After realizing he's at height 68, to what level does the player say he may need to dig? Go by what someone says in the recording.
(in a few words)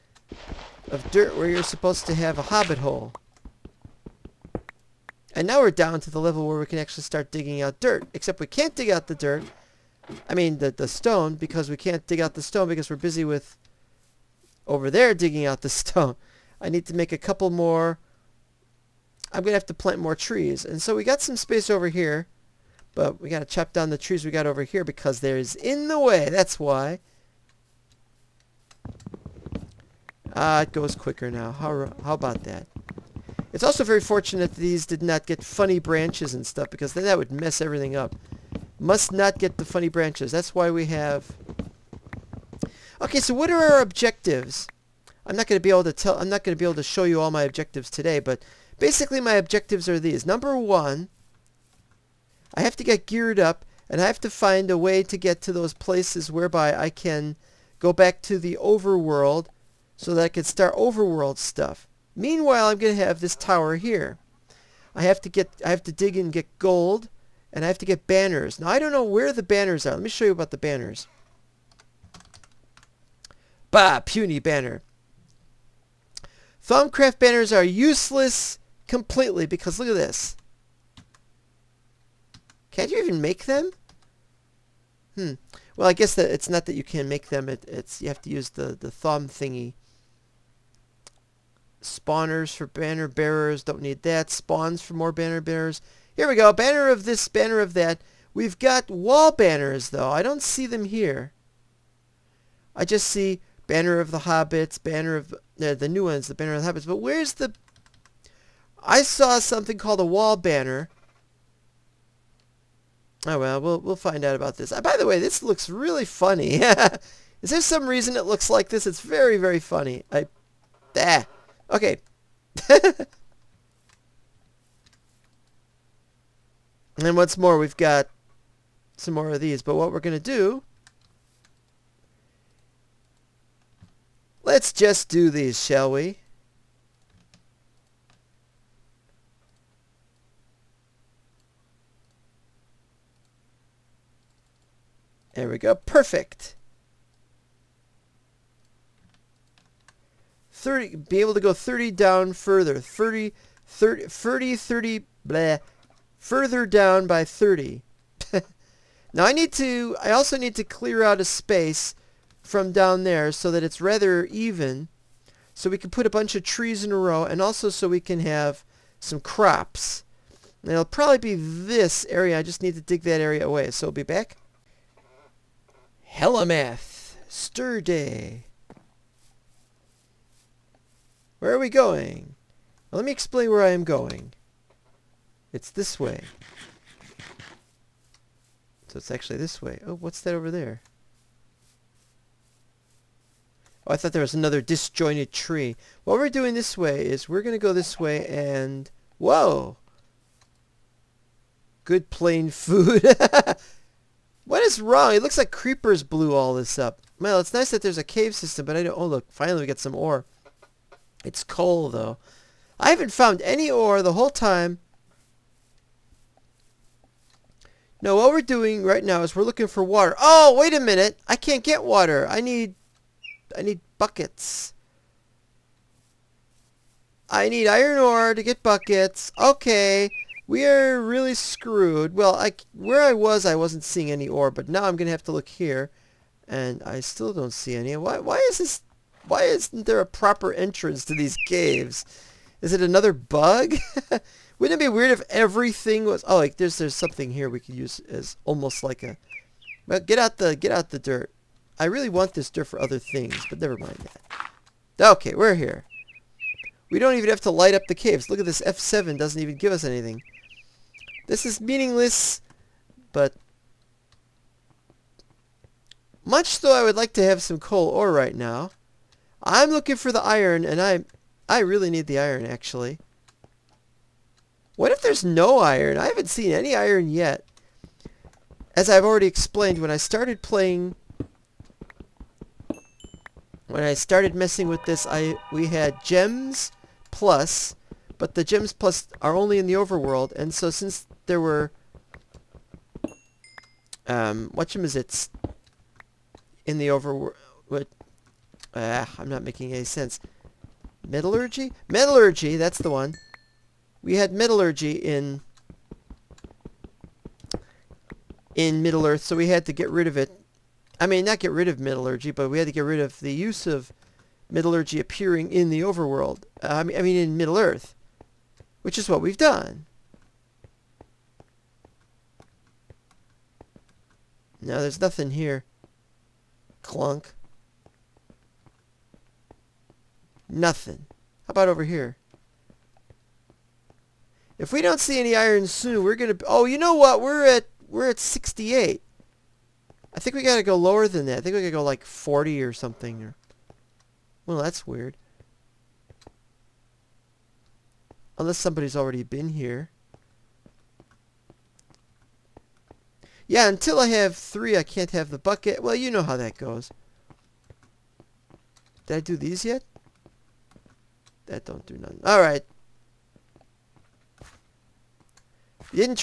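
40.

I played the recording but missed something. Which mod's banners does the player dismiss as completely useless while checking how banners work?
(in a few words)
Thaumcraft.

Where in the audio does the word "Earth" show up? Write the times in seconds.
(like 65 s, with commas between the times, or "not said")
309 s, 317 s.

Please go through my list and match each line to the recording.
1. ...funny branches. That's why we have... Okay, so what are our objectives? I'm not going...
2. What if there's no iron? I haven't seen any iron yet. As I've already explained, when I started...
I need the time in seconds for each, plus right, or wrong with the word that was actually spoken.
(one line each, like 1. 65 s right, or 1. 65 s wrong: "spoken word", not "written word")
1. 39 s right
2. 274 s right.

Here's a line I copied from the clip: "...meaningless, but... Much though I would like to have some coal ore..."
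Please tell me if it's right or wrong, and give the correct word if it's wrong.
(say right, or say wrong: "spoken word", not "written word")
right.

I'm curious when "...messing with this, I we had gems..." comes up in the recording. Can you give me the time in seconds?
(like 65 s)
284 s.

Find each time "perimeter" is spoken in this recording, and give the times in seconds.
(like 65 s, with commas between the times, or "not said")
not said.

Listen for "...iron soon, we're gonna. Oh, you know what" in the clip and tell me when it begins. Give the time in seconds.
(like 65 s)
335 s.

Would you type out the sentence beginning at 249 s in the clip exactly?
Well, get out the get out the dirt.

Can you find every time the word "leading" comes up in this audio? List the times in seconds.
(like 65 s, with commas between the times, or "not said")
not said.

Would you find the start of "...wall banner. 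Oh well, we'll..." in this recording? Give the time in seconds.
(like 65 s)
110 s.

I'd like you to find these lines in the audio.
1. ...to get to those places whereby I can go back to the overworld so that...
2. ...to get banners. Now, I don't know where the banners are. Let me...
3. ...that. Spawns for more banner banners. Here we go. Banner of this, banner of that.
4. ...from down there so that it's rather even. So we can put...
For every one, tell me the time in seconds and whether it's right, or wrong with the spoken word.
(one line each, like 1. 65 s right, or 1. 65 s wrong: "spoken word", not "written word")
1. 55 s right
2. 67 s right
3. 94 s wrong: "bearers", not "banners"
4. 162 s right.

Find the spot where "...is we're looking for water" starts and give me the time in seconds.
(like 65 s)
219 s.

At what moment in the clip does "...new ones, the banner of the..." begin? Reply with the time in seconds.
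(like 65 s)
105 s.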